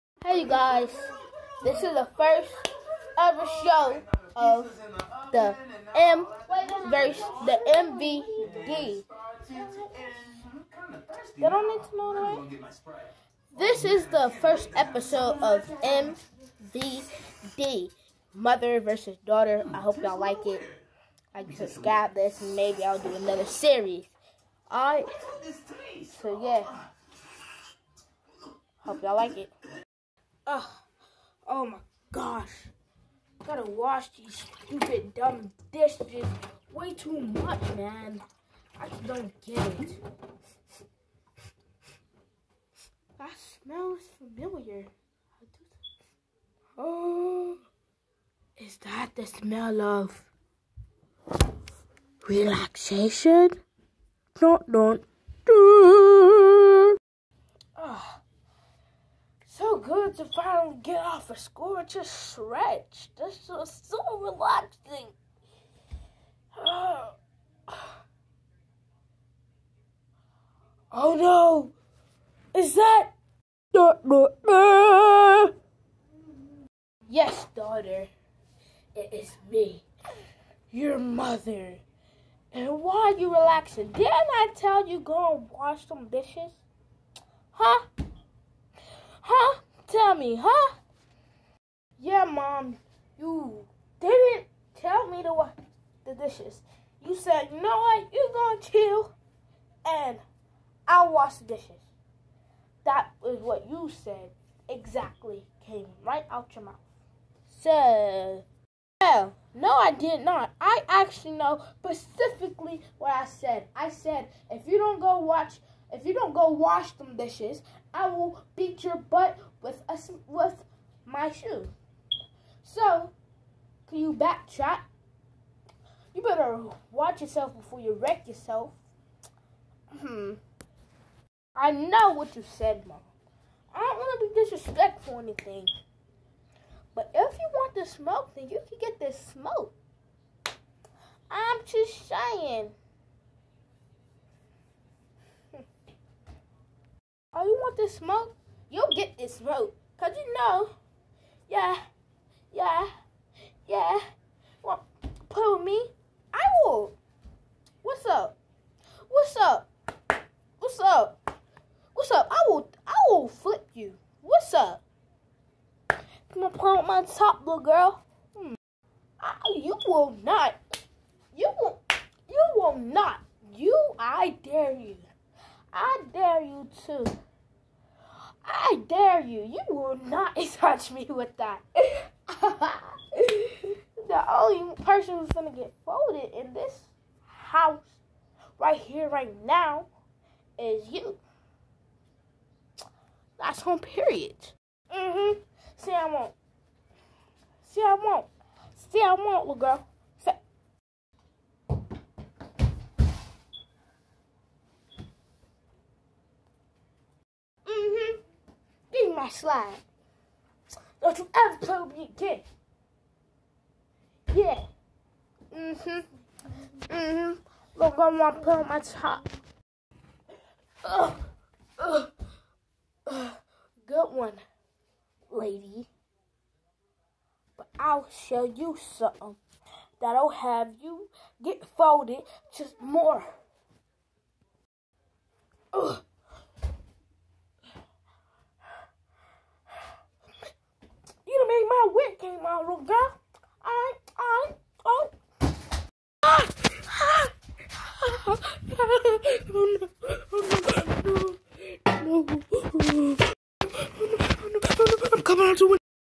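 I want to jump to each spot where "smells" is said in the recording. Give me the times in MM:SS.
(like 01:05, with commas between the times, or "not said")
00:43, 00:49.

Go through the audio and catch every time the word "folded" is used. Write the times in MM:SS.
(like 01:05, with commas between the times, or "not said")
03:05, 03:51.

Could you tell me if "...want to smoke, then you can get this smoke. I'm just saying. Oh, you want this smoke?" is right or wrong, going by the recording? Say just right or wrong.
right.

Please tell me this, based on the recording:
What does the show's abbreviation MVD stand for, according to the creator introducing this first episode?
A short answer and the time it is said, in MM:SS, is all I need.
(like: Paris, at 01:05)
Mother versus Daughter, at 00:18.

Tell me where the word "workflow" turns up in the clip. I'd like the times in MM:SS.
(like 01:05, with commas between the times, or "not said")
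not said.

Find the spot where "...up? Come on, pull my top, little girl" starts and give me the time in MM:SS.
02:44.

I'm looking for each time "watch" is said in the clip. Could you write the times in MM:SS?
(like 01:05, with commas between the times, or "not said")
01:55, 02:06.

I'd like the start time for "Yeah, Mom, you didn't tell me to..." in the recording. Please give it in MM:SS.
01:31.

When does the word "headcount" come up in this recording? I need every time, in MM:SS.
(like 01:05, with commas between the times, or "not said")
not said.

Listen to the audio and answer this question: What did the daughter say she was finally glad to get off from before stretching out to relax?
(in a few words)
School.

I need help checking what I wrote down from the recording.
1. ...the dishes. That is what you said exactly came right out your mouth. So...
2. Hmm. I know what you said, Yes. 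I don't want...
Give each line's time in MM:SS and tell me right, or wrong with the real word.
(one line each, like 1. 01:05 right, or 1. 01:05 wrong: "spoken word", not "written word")
1. 01:41 right
2. 02:09 wrong: "Mom", not "Yes".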